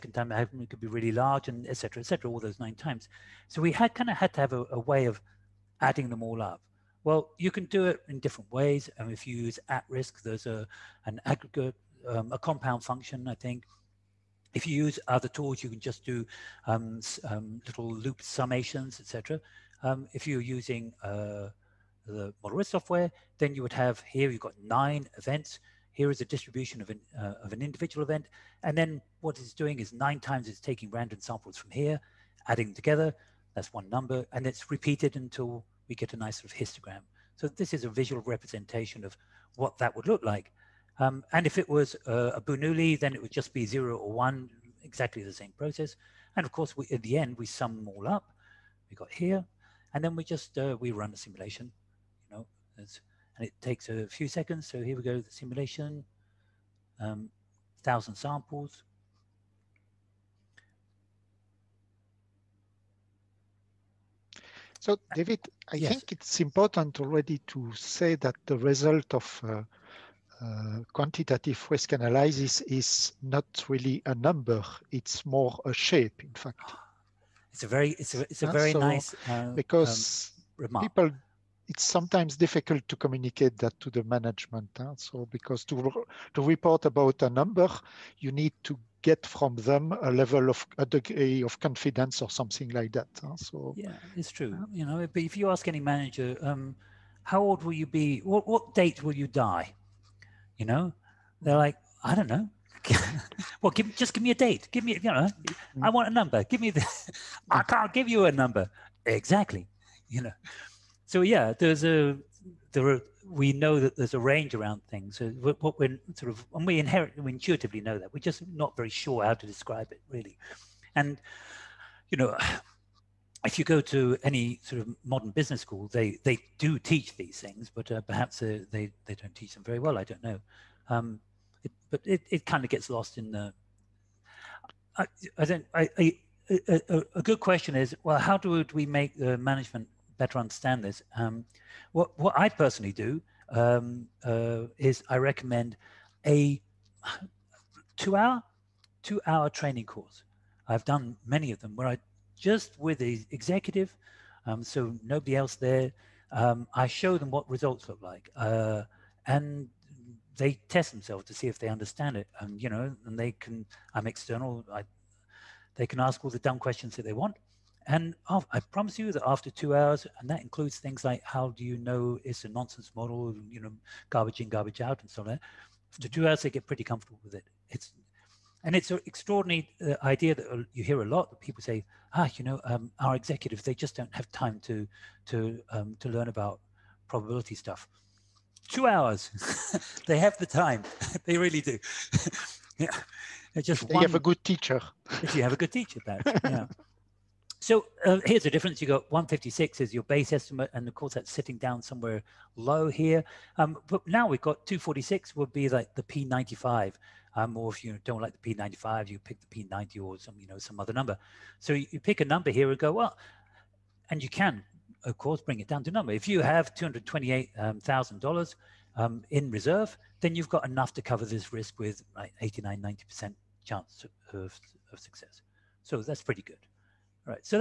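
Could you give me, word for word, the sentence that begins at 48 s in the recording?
We got here, and then we just uh, we run a simulation.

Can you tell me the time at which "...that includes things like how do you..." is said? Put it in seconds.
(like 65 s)
170 s.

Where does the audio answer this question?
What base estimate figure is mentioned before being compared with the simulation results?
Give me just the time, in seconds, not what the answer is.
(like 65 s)
199 s.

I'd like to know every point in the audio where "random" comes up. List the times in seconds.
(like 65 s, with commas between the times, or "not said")
30 s.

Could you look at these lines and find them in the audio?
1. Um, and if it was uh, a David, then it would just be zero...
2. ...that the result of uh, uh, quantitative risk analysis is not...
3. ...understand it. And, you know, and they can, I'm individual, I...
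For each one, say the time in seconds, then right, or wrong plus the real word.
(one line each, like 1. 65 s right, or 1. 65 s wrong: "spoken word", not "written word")
1. 40 s wrong: "Bernoulli", not "David"
2. 68 s right
3. 161 s wrong: "external", not "individual".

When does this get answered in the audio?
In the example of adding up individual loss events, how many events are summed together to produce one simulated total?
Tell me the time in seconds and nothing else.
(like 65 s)
24 s.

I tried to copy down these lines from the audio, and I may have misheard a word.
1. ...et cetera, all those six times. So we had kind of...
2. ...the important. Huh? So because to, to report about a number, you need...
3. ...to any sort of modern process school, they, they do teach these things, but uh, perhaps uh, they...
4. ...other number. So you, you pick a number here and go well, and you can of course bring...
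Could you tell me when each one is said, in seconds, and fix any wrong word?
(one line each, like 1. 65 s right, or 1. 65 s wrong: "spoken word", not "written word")
1. 1 s wrong: "nine", not "six"
2. 83 s wrong: "management", not "important"
3. 123 s wrong: "business", not "process"
4. 210 s right.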